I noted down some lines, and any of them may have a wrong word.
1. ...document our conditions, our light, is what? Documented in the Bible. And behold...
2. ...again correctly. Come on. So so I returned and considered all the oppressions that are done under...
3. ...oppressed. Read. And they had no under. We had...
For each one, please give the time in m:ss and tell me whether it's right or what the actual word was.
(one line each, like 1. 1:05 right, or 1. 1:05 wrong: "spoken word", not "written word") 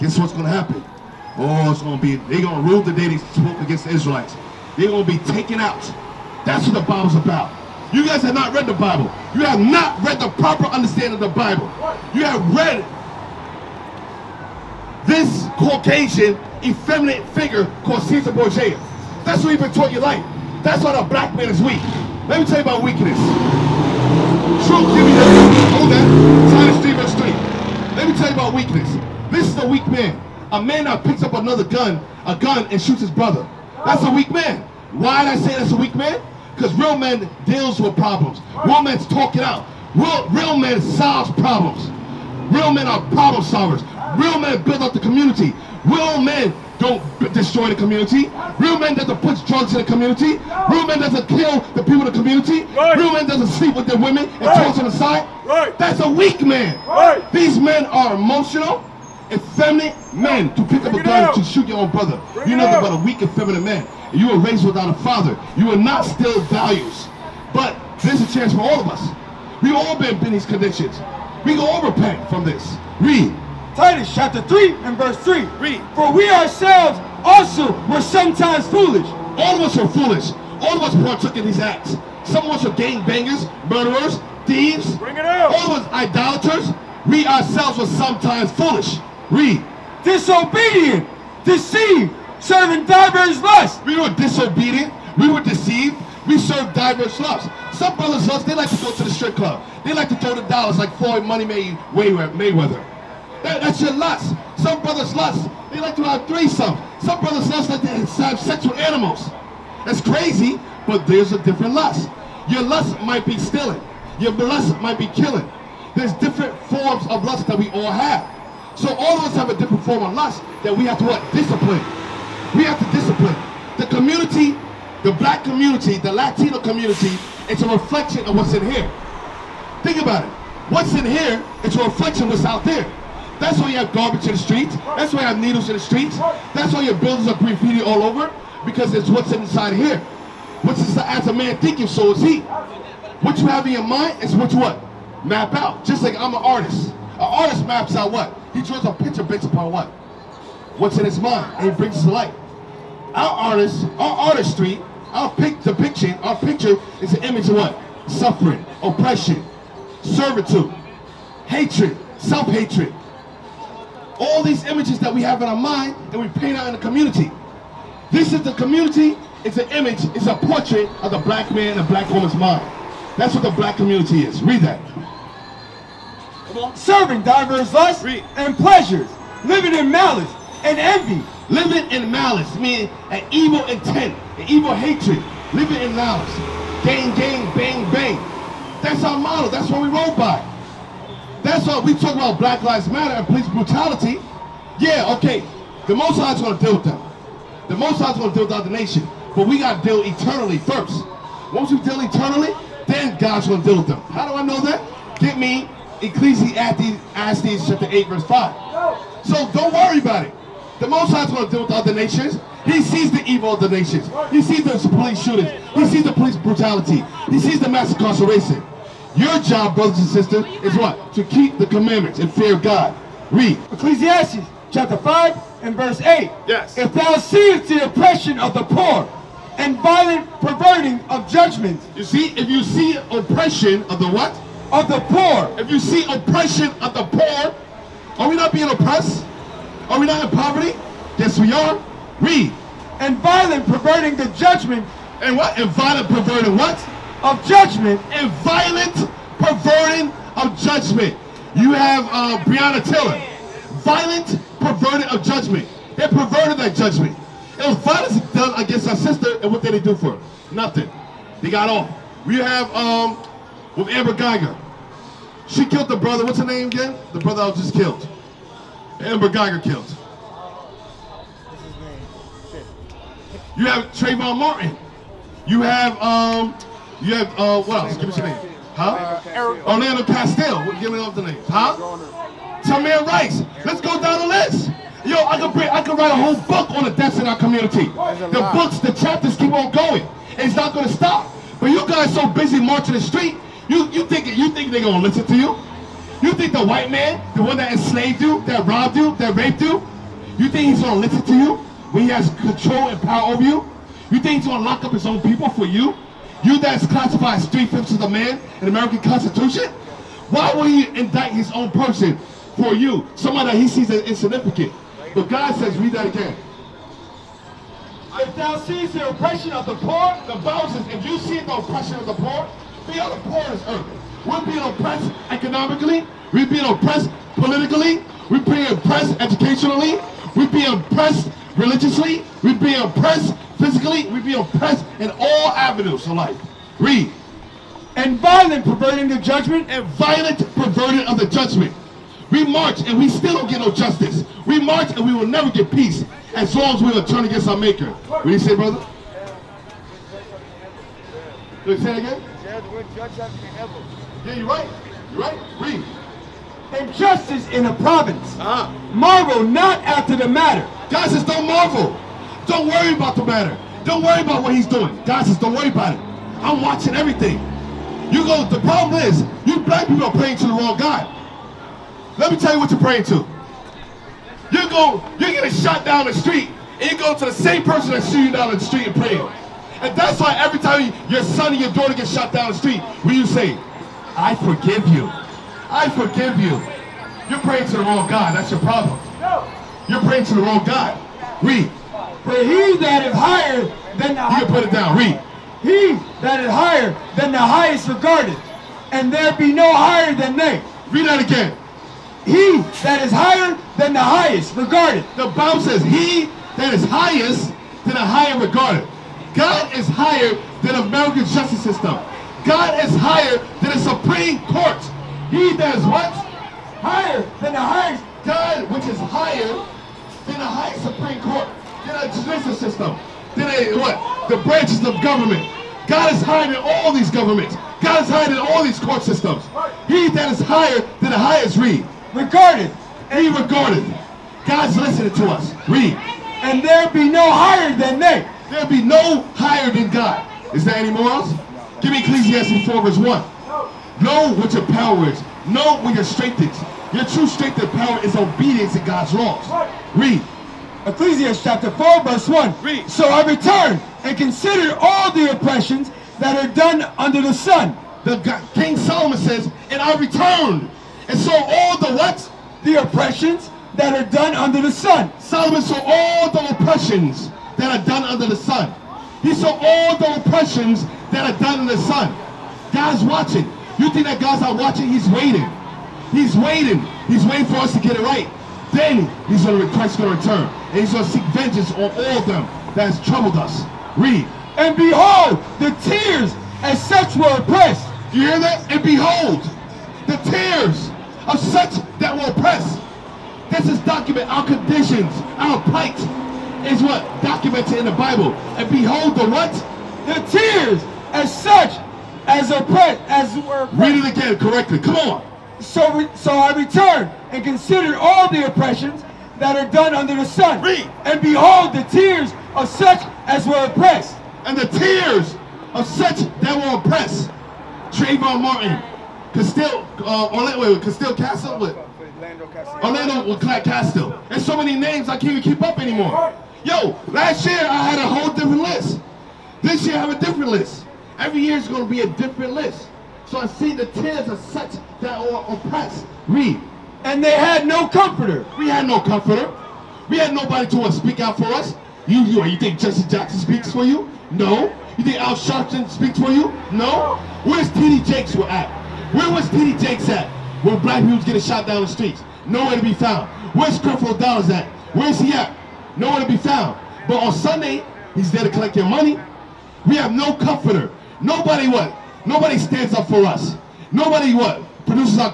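1. 8:13 wrong: "plight", not "light"
2. 8:24 right
3. 8:55 wrong: "comforter", not "under".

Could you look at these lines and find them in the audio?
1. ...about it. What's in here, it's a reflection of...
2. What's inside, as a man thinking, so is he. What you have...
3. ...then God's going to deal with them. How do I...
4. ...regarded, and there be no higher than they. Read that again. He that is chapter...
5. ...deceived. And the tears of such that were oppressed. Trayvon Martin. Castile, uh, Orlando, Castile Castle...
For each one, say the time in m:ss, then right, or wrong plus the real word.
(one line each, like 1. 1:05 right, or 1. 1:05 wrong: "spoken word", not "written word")
1. 2:09 right
2. 2:20 right
3. 3:22 right
4. 6:37 wrong: "higher", not "chapter"
5. 8:33 wrong: "oppressed", not "deceived".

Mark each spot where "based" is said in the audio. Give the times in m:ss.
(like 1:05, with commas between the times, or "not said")
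2:29.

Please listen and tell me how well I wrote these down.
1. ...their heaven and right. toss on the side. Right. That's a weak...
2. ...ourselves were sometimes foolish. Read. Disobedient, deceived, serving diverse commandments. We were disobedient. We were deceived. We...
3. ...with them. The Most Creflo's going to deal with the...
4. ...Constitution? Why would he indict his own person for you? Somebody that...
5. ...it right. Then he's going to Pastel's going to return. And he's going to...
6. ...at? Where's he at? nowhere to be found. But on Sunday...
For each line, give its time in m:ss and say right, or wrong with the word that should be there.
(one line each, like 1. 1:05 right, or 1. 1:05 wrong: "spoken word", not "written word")
1. 0:53 wrong: "women", not "heaven"
2. 1:27 wrong: "lusts", not "commandments"
3. 3:16 wrong: "High", not "Creflo"
4. 5:08 right
5. 7:57 wrong: "Christ", not "Pastel"
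6. 9:14 right.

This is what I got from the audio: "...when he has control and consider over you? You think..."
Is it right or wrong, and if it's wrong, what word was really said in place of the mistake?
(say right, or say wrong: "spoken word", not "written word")
wrong: "power", not "consider".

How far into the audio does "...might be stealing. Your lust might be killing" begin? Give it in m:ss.
1:52.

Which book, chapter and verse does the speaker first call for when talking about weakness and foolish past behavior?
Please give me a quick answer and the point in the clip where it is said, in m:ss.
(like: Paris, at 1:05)
Titus 3:3, at 0:26.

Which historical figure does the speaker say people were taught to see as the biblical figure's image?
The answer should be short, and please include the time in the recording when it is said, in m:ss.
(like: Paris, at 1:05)
Caesar Borgia, at 0:18.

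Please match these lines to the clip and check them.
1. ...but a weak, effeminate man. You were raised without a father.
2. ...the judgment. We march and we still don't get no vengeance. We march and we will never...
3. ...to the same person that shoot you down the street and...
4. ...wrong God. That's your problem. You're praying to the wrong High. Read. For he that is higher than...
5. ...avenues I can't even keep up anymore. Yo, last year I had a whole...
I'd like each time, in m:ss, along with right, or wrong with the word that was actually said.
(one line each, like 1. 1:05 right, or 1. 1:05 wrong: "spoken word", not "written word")
1. 1:02 right
2. 5:41 wrong: "justice", not "vengeance"
3. 6:17 right
4. 6:27 wrong: "God", not "High"
5. 8:44 wrong: "names", not "avenues".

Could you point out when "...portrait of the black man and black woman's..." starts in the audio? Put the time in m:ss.
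2:50.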